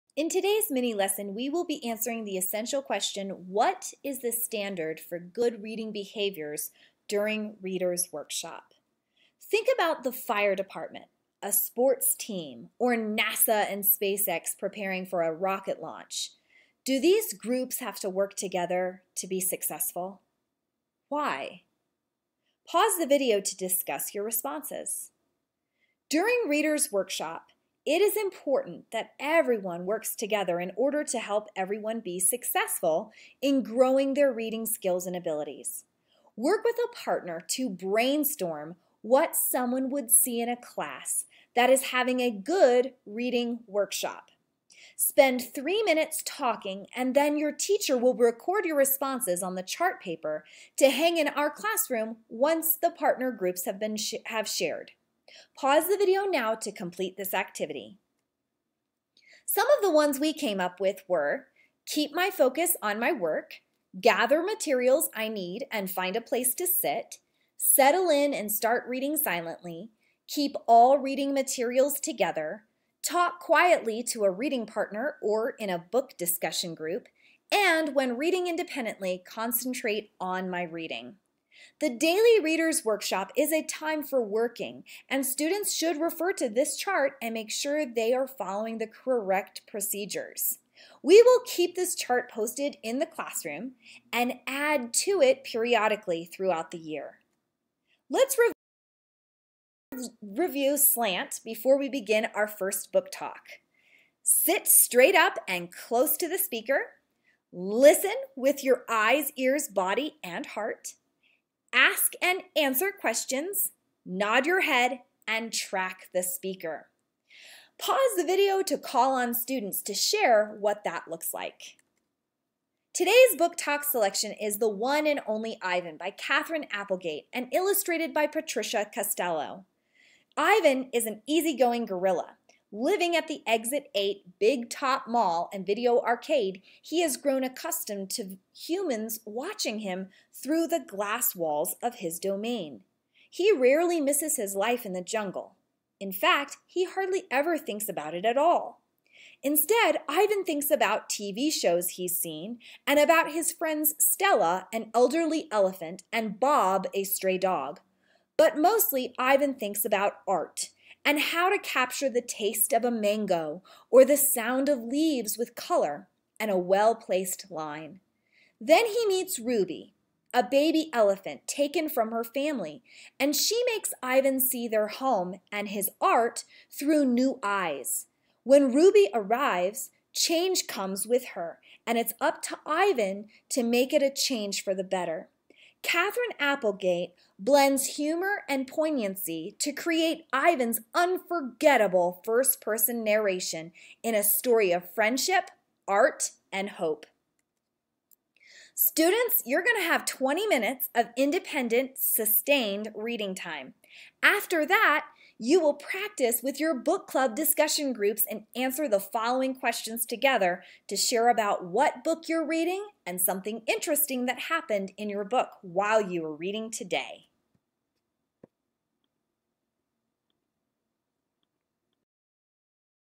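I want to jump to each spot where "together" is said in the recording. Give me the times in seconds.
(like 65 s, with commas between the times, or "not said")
18 s, 30 s, 71 s, 210 s.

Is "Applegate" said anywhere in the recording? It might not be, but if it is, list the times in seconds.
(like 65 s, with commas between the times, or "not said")
126 s, 186 s.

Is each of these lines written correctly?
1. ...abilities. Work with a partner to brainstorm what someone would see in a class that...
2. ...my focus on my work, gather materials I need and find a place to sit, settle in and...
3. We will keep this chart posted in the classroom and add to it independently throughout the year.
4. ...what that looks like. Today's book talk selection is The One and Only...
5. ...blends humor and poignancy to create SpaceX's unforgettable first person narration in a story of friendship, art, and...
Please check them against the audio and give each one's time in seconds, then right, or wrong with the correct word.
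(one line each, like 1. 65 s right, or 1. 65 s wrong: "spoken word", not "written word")
1. 35 s right
2. 62 s right
3. 91 s wrong: "periodically", not "independently"
4. 120 s right
5. 187 s wrong: "Ivan", not "SpaceX".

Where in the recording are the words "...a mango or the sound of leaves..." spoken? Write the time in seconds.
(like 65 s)
162 s.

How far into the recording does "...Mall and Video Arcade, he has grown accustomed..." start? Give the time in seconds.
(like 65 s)
135 s.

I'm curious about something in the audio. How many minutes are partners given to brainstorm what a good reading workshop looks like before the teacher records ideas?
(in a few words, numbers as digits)
3.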